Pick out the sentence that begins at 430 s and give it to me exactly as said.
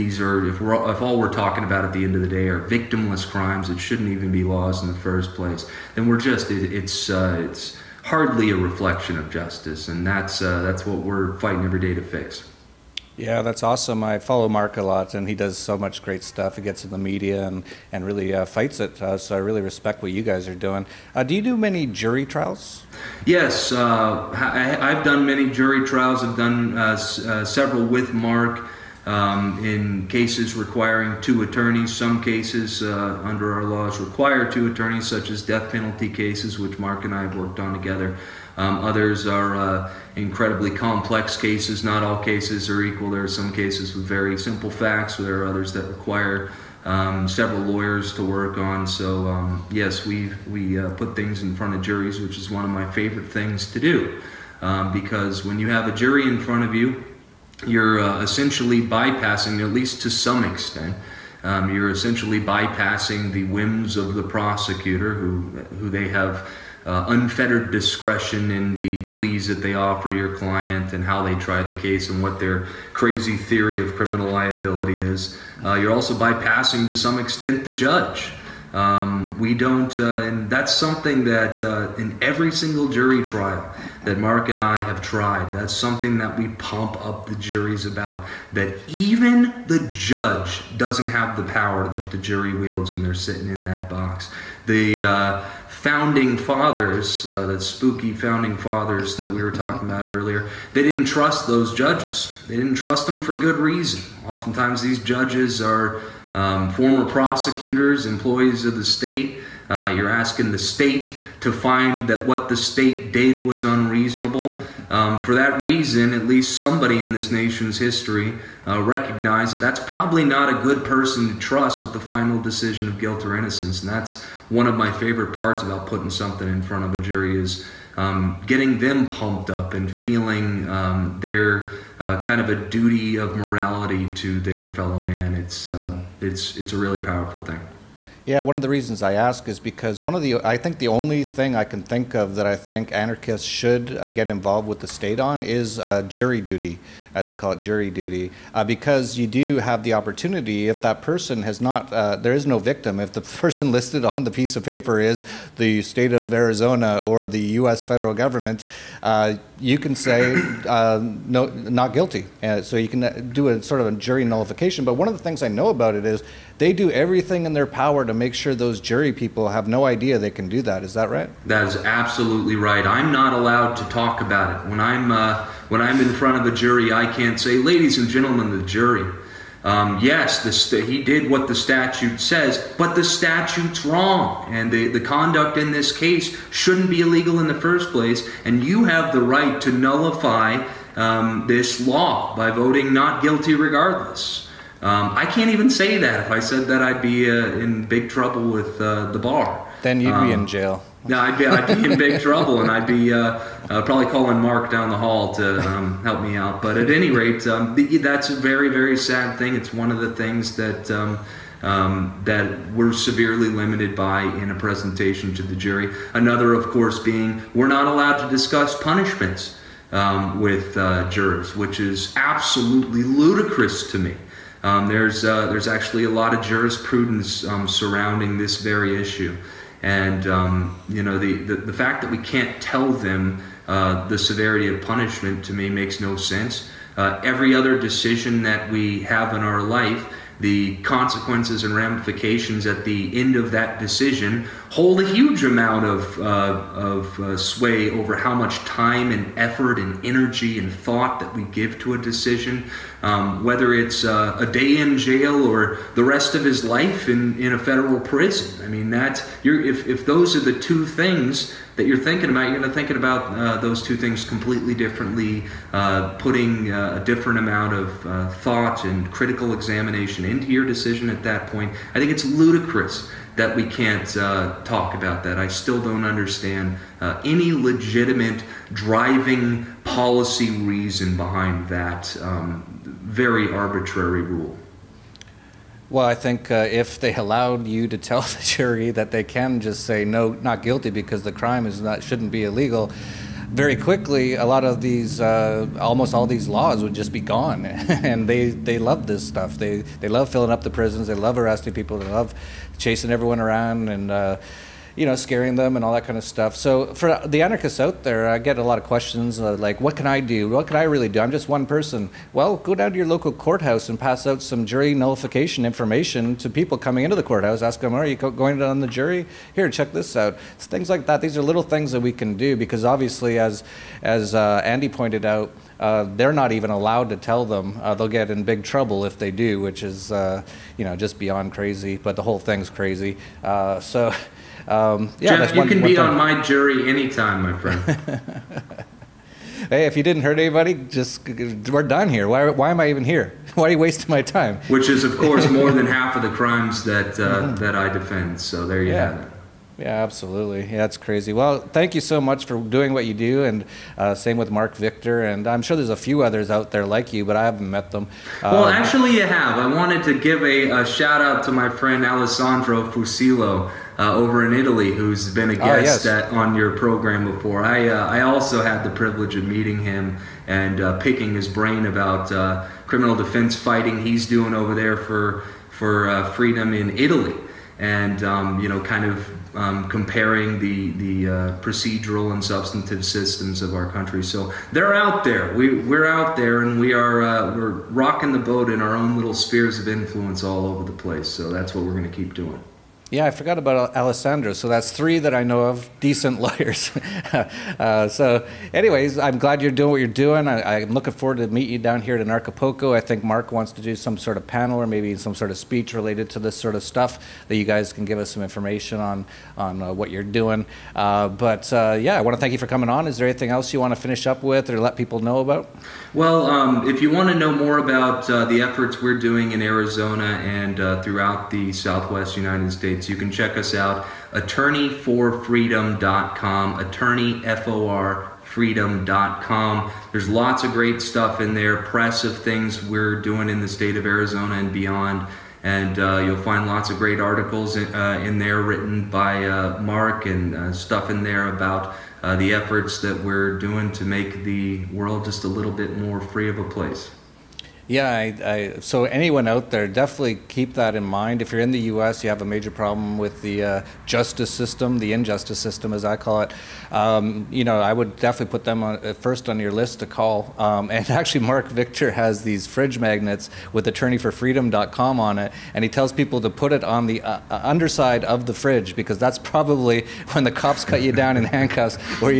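There's lots of great stuff in there, press of things we're doing in the state of Arizona and beyond.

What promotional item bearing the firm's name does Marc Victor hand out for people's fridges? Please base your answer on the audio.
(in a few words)
Fridge magnets.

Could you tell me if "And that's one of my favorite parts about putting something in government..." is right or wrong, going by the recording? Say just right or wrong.
wrong.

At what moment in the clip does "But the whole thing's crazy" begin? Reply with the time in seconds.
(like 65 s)
331 s.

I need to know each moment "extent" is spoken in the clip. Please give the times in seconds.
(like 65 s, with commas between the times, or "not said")
60 s, 77 s.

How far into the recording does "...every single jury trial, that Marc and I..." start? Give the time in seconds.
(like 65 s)
82 s.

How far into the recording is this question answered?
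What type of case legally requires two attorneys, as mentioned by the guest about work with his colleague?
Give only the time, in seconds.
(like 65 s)
35 s.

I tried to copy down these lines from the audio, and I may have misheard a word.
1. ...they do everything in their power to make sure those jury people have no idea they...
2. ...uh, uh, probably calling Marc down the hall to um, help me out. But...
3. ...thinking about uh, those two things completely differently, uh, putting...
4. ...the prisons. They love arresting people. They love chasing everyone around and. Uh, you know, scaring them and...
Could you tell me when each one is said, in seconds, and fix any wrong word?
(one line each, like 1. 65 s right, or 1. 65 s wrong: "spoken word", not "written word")
1. 166 s right
2. 203 s right
3. 262 s right
4. 300 s right.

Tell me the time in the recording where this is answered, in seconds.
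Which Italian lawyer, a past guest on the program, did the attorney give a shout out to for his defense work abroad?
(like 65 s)
362 s.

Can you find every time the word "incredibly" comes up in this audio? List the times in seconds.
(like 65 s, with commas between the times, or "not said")
40 s.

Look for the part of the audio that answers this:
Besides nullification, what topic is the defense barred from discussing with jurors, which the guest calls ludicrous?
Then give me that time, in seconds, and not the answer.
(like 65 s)
218 s.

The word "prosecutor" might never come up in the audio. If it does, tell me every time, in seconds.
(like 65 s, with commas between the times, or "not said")
64 s, 107 s.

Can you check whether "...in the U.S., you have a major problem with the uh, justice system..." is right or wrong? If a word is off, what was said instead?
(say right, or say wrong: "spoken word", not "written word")
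right.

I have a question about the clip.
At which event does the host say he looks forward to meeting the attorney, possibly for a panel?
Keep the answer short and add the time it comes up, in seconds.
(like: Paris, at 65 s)
Anarchapulco, at 402 s.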